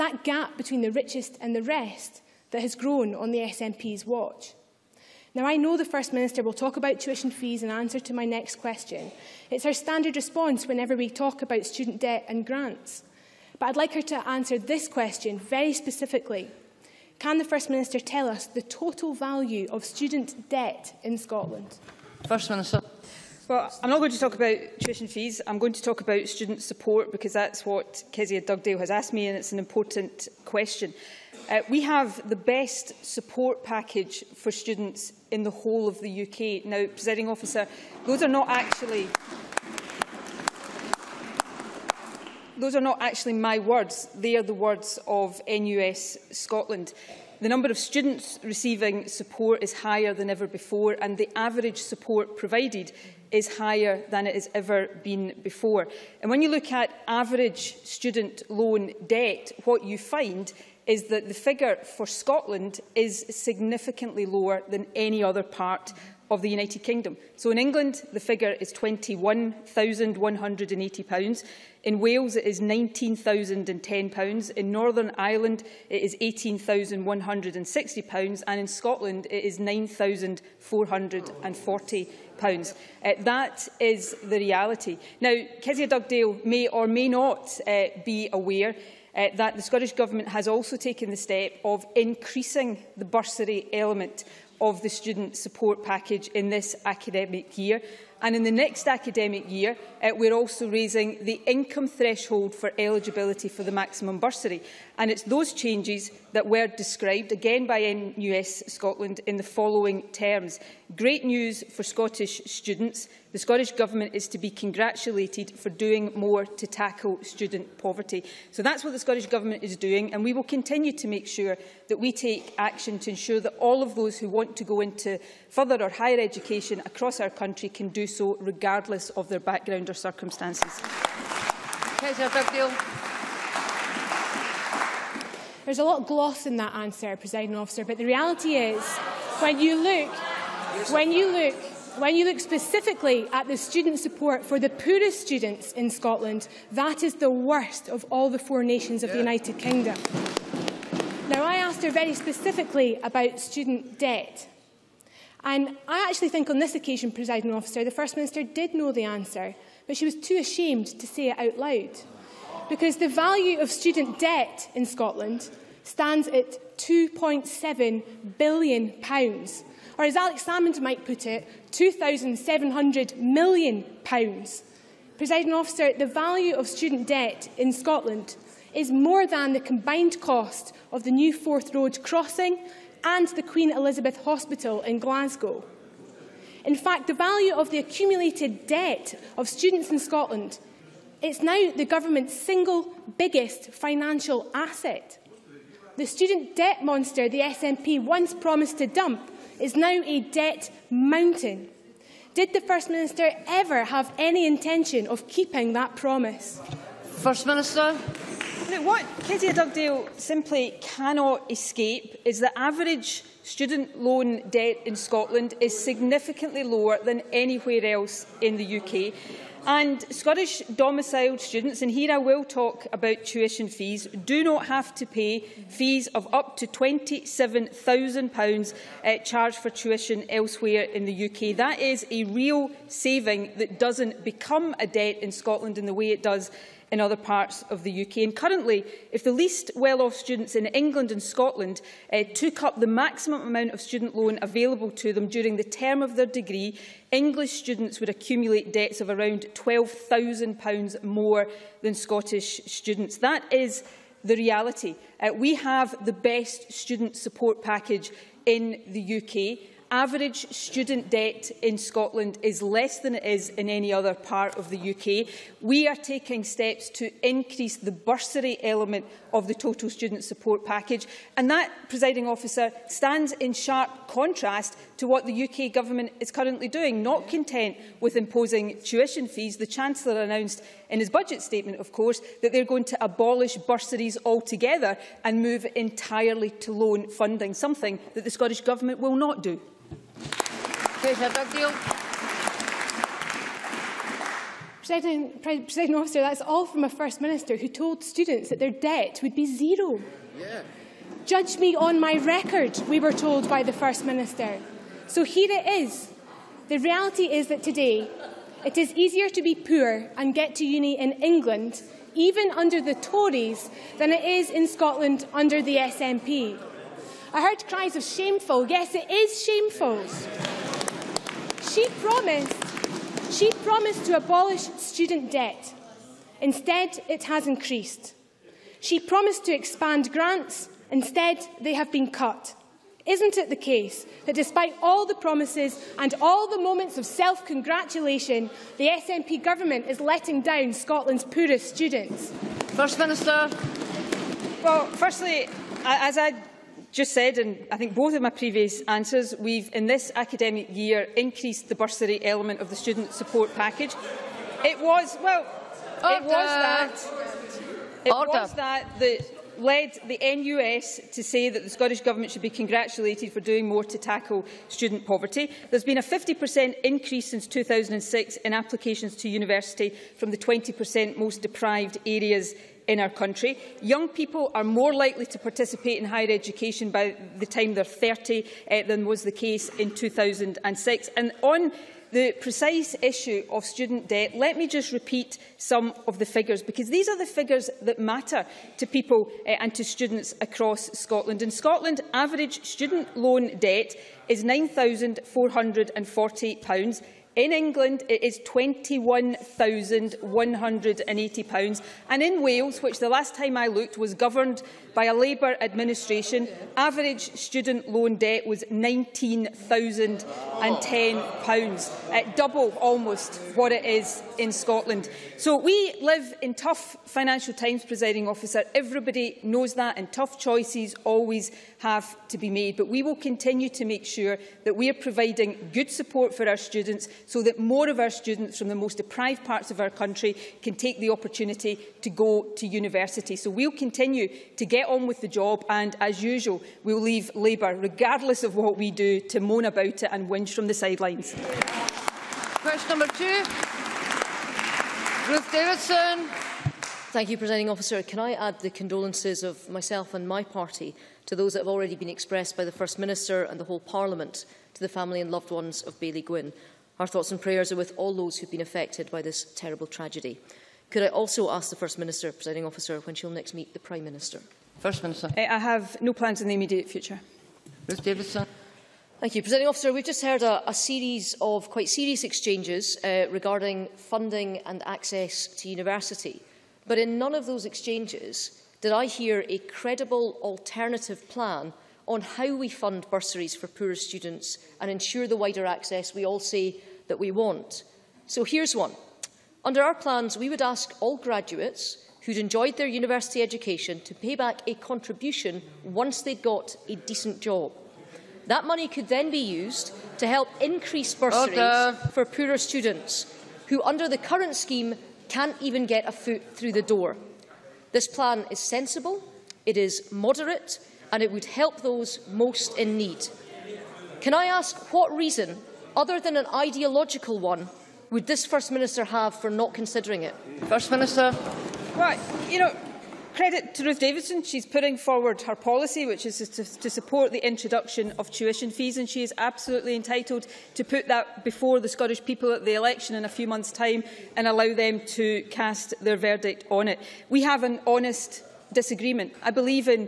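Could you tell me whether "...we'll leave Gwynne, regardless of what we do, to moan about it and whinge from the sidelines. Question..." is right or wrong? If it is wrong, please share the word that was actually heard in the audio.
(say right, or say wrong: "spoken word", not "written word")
wrong: "Labour", not "Gwynne".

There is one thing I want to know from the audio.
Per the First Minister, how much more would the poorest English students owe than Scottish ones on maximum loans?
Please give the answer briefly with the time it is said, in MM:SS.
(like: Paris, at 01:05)
£12,000, at 04:09.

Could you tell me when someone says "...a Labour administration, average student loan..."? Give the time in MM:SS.
06:45.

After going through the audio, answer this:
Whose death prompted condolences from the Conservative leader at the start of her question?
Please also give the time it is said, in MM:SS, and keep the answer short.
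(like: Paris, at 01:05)
Bailey Gwynne, at 07:35.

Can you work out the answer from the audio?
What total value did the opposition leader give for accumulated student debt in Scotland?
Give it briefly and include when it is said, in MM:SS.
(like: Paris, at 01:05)
£2.7 billion, at 02:46.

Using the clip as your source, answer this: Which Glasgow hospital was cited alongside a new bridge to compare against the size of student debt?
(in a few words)
Queen Elizabeth Hospital.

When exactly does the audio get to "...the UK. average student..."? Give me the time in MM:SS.
04:18.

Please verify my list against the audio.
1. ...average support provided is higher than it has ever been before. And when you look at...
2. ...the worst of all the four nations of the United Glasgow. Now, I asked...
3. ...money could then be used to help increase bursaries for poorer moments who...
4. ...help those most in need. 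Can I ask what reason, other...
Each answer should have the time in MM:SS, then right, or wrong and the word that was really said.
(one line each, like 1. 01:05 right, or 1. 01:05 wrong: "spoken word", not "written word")
1. 00:51 right
2. 02:27 wrong: "Kingdom", not "Glasgow"
3. 08:18 wrong: "students", not "moments"
4. 08:31 right.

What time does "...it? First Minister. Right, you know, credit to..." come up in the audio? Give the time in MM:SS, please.
08:40.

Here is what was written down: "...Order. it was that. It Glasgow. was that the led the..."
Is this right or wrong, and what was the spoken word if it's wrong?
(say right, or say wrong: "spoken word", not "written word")
wrong: "Order", not "Glasgow".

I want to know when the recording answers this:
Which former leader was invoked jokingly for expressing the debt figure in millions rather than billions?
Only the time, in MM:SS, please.
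02:50.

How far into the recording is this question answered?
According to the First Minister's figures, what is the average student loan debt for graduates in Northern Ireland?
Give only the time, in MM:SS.
01:16.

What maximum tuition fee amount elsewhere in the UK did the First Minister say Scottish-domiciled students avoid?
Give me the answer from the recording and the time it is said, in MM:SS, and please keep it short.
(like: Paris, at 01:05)
£27,000, at 03:46.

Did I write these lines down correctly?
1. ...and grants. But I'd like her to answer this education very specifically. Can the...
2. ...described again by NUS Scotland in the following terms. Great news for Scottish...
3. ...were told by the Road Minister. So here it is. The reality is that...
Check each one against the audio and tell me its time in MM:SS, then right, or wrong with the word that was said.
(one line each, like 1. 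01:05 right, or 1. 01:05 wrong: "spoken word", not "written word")
1. 00:12 wrong: "question", not "education"
2. 01:46 right
3. 05:03 wrong: "First", not "Road".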